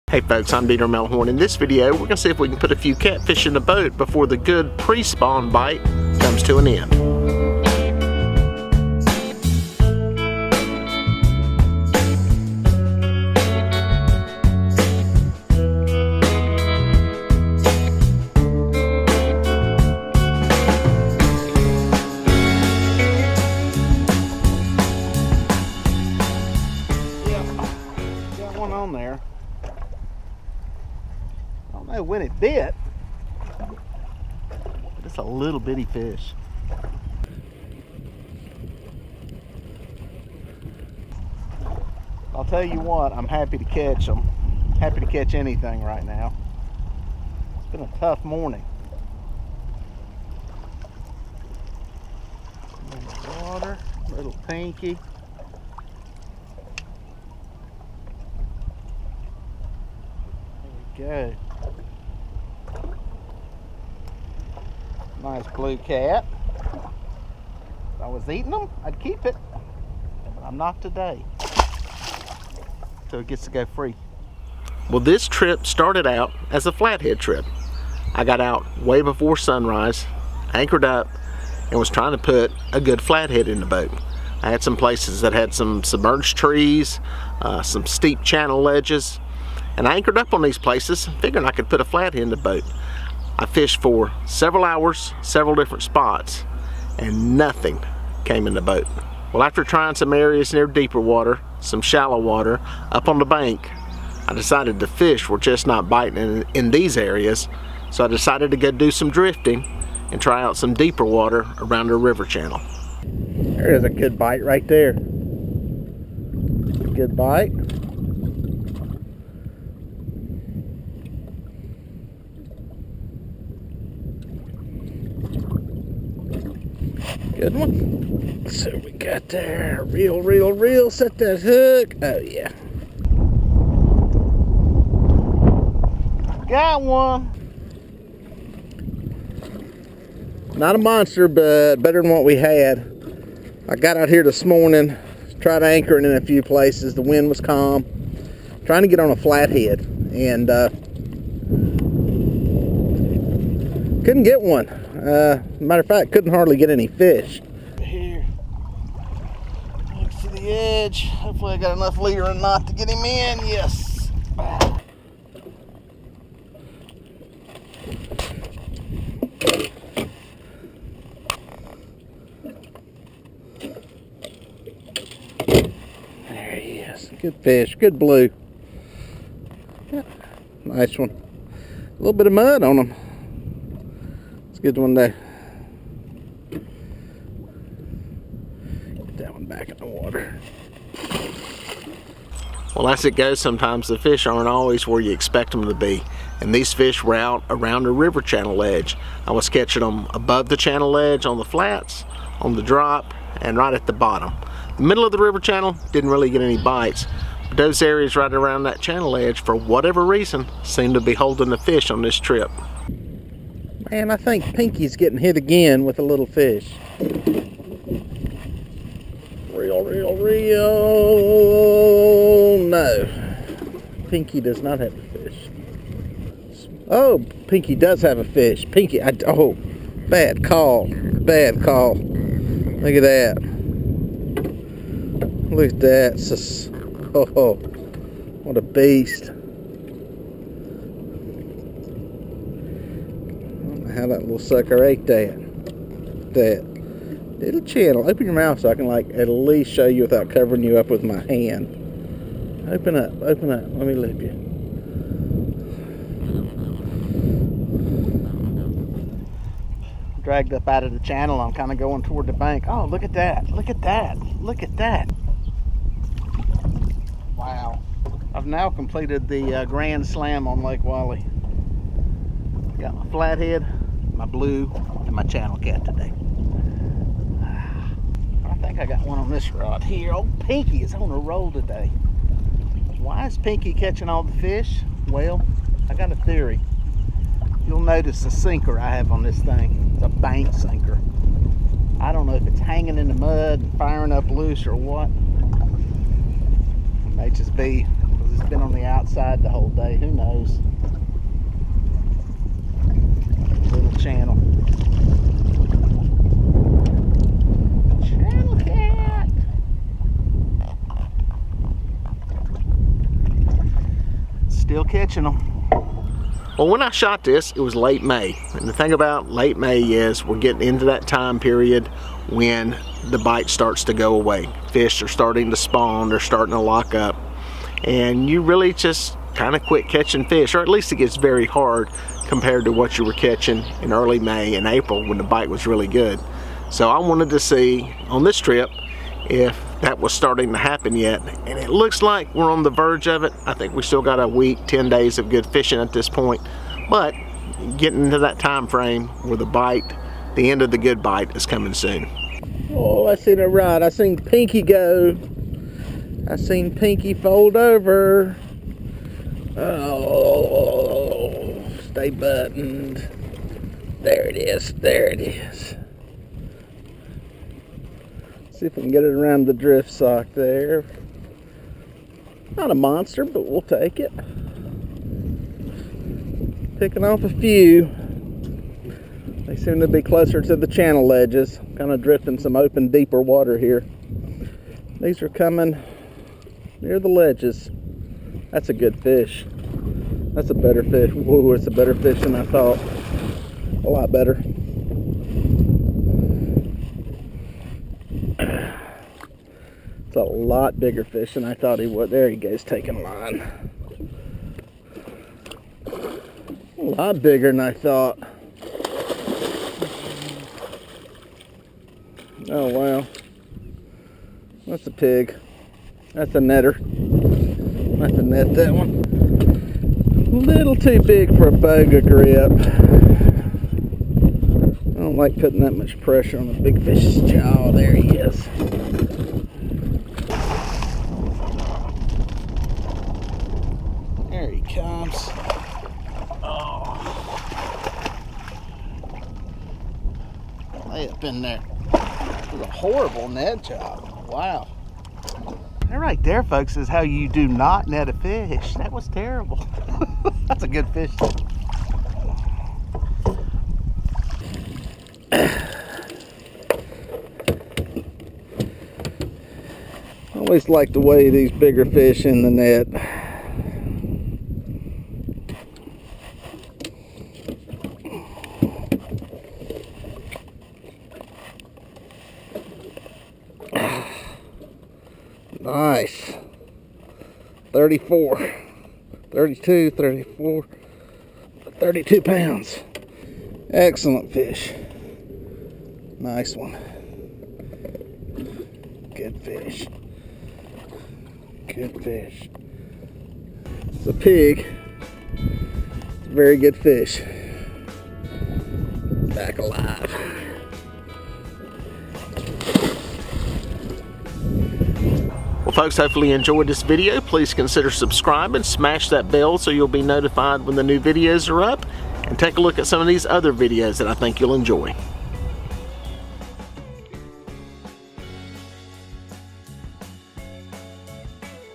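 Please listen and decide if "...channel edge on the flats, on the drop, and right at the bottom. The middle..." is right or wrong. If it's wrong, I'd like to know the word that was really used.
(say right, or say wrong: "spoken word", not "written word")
right.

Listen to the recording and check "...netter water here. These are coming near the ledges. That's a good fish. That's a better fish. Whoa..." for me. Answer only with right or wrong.
wrong.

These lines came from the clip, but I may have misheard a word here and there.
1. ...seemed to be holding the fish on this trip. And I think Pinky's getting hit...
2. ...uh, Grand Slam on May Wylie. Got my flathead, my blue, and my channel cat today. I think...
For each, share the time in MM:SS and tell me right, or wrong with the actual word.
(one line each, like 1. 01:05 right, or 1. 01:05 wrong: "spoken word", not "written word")
1. 03:30 right
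2. 04:29 wrong: "Lake", not "May".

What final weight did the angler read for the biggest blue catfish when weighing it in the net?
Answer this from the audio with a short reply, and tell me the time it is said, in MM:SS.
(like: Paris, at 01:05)
32 pounds, at 08:01.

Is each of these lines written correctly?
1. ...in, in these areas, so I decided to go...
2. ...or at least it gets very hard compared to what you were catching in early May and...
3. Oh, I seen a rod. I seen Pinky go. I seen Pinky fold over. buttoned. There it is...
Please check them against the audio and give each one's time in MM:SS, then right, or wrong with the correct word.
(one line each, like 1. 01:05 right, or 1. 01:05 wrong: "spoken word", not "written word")
1. 01:46 right
2. 05:30 right
3. 05:52 right.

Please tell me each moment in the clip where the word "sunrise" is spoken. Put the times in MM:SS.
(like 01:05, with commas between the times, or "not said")
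01:19.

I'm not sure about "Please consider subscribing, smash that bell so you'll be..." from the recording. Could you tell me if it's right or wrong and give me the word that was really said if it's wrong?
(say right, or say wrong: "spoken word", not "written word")
right.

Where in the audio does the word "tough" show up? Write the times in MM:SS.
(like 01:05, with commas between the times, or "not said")
00:47.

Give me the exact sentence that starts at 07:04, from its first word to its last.
I don't like putting that much pressure on the big fish's jaw.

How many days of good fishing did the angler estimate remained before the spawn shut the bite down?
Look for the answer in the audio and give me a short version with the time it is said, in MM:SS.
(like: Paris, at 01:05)
10 days, at 05:44.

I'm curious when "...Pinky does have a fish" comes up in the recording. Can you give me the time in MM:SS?
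03:47.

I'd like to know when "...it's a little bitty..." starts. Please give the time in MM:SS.
00:35.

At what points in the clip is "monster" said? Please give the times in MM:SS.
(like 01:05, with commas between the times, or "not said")
02:20, 06:12.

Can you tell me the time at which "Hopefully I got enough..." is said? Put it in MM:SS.
02:41.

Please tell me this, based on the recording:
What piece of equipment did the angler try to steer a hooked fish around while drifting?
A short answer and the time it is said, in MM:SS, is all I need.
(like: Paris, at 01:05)
Drift sock, at 06:09.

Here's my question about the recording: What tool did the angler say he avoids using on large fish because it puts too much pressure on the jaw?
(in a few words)
Boga grip.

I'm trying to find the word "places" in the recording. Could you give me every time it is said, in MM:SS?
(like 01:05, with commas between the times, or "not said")
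01:24, 01:30, 02:26.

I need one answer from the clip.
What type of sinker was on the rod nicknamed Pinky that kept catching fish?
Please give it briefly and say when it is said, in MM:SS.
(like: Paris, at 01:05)
Bank sinker, at 04:50.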